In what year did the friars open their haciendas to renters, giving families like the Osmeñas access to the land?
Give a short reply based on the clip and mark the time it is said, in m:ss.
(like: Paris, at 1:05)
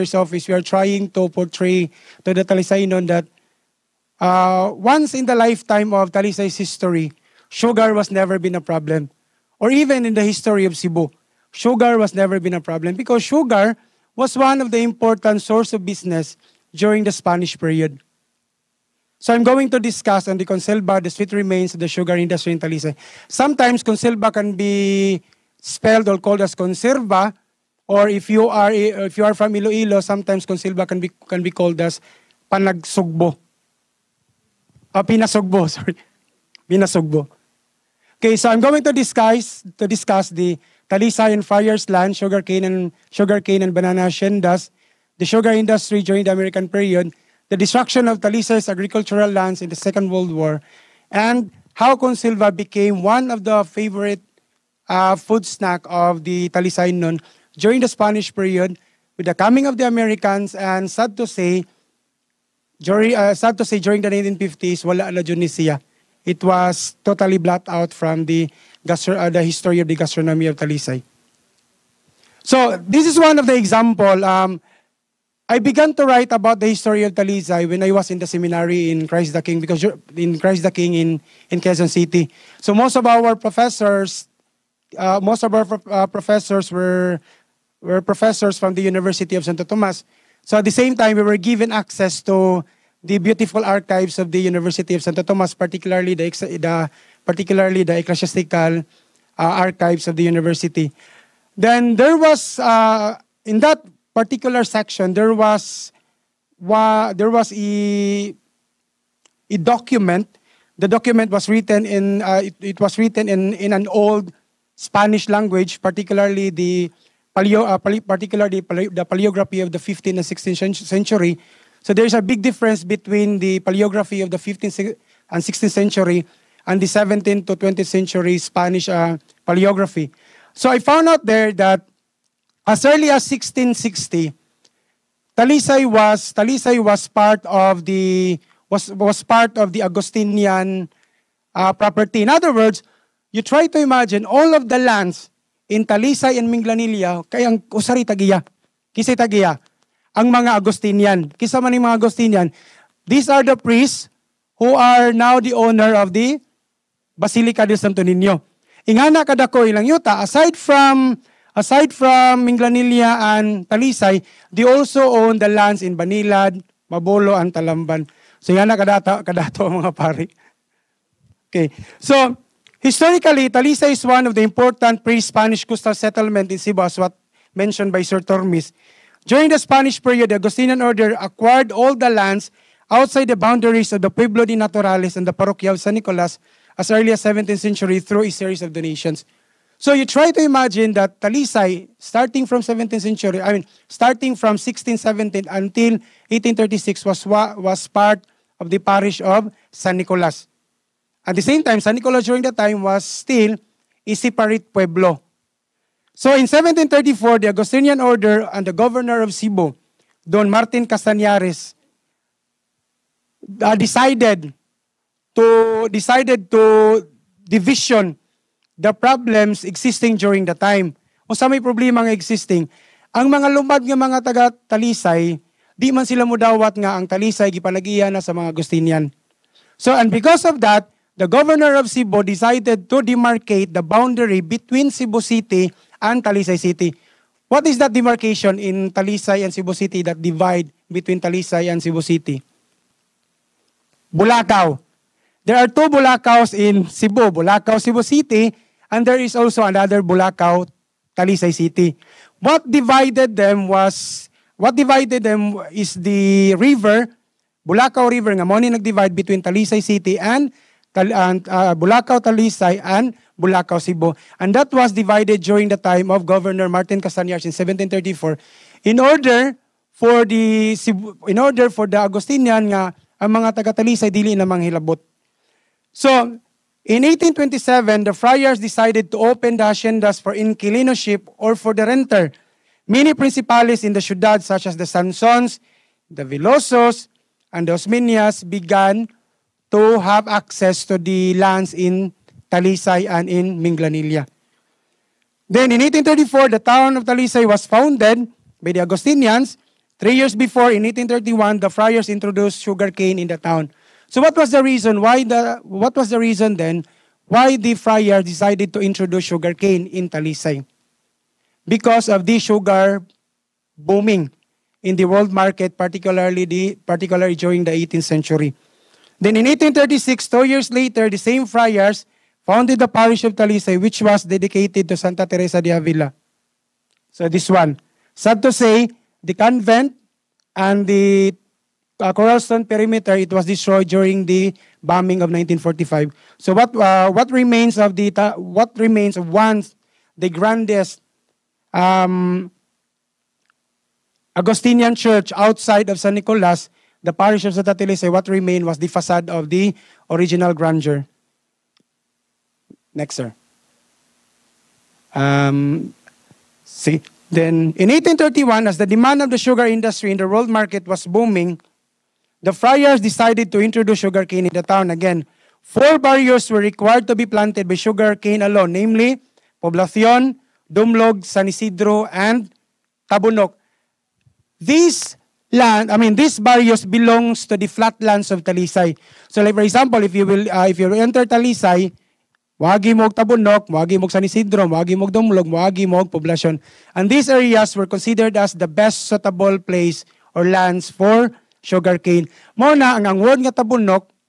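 1827, at 4:37.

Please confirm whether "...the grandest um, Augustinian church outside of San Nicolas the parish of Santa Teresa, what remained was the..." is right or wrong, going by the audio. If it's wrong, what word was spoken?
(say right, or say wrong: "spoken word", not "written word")
right.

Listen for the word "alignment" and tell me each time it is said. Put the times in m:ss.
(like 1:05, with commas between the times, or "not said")
not said.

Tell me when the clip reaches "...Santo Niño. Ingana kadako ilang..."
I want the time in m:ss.
2:37.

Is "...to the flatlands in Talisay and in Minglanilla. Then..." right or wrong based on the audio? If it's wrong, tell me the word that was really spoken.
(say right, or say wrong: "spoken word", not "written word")
wrong: "lands", not "flatlands".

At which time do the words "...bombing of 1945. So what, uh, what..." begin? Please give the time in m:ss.
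5:34.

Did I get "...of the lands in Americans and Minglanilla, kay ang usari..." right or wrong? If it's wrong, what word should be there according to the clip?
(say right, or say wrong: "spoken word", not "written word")
wrong: "Talisay", not "Americans".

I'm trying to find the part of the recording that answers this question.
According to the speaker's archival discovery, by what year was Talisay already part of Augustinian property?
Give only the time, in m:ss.
2:13.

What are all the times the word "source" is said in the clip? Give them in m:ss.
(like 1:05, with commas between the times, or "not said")
0:15.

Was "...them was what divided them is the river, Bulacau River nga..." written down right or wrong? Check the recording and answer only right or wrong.
right.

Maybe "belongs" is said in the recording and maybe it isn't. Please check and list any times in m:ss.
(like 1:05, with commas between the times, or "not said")
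6:16.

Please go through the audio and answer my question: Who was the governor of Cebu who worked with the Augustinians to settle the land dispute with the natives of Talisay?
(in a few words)
Don Martin Castañares.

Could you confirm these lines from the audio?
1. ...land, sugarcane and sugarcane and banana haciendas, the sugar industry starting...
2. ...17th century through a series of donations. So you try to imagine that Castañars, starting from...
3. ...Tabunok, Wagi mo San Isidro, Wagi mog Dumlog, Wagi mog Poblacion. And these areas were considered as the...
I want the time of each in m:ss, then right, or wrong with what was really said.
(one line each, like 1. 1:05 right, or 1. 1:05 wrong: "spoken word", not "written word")
1. 0:41 wrong: "during", not "starting"
2. 3:07 wrong: "Talisay", not "Castañars"
3. 6:23 right.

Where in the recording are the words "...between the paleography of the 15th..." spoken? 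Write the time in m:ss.
2:02.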